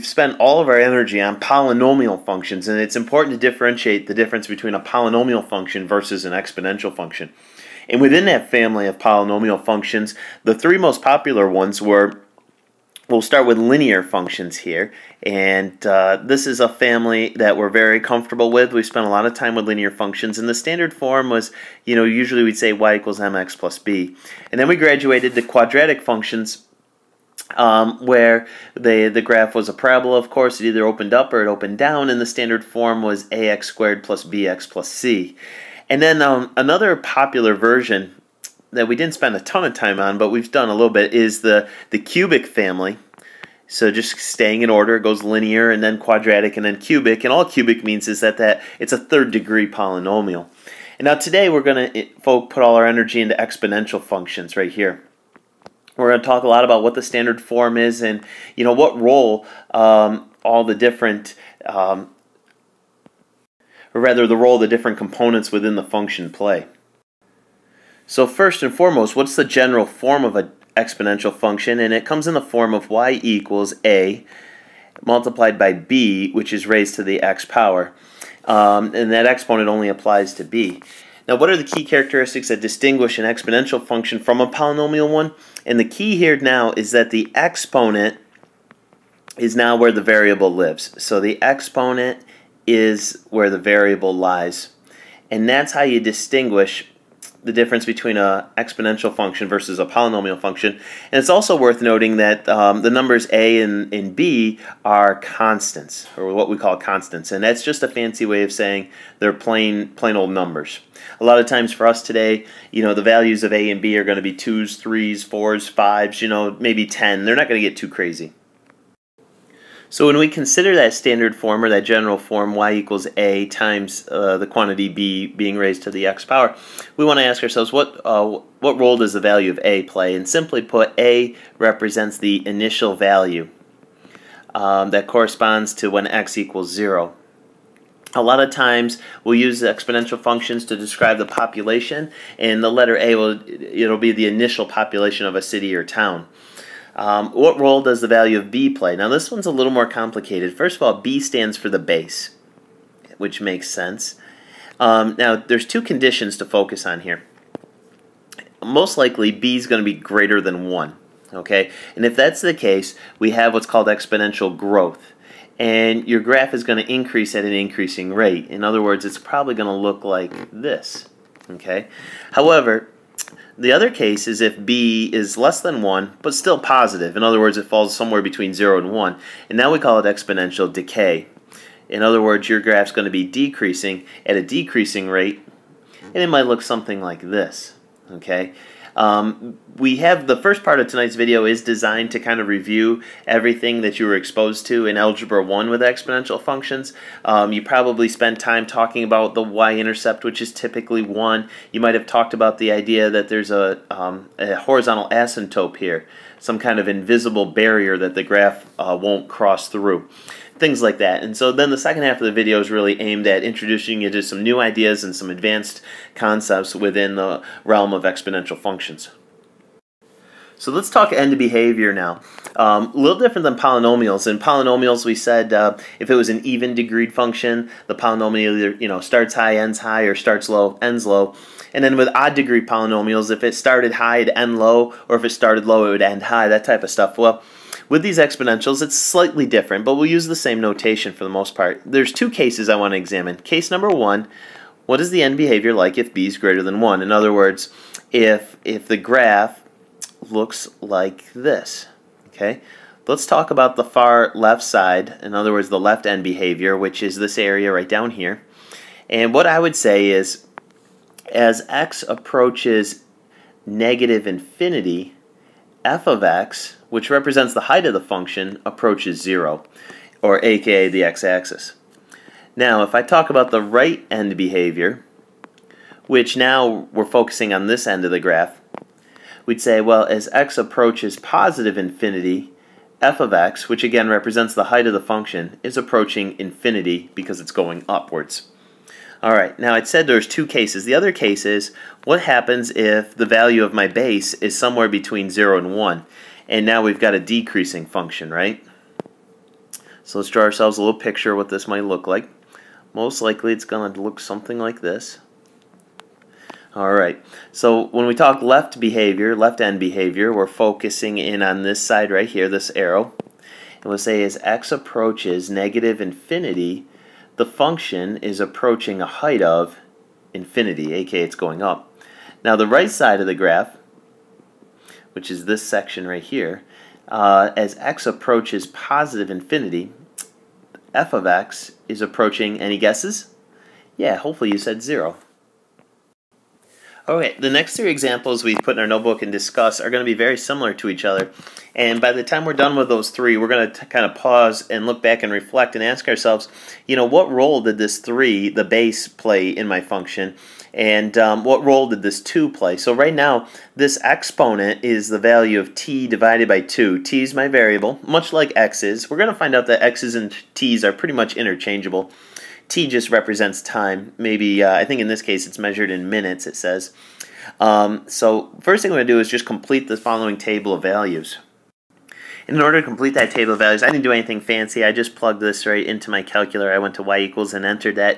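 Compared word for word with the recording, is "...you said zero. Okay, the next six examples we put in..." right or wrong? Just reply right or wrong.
wrong.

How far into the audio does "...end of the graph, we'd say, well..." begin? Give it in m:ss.
4:37.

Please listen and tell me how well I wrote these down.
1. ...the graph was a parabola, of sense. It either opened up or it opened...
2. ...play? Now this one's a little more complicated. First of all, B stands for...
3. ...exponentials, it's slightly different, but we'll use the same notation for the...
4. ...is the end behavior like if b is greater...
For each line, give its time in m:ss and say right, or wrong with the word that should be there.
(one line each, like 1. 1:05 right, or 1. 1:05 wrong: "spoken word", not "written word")
1. 0:29 wrong: "course", not "sense"
2. 2:28 right
3. 3:58 right
4. 4:04 right.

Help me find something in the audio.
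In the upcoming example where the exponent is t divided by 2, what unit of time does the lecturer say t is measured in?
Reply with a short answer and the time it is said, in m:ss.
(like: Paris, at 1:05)
minutes, at 6:06.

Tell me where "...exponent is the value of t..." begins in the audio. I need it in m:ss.
5:54.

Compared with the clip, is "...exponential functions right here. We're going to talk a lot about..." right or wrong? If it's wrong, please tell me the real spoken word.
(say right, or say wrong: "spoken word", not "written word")
right.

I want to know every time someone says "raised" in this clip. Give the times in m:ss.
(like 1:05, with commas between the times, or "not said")
1:16, 2:05.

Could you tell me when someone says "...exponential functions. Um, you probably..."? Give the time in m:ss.
3:15.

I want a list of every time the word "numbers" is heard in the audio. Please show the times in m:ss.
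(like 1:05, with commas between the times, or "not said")
1:42, 1:50, 4:03.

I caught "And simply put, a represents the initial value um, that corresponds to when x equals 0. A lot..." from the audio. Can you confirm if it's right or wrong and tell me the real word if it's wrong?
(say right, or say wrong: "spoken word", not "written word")
right.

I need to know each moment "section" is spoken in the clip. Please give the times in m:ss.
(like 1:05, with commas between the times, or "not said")
5:25.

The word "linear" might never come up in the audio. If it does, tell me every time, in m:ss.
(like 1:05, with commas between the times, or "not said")
0:13, 0:19, 0:45.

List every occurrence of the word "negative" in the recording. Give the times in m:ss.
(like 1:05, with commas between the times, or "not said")
4:23, 5:15.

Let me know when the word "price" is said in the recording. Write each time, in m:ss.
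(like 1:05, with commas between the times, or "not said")
not said.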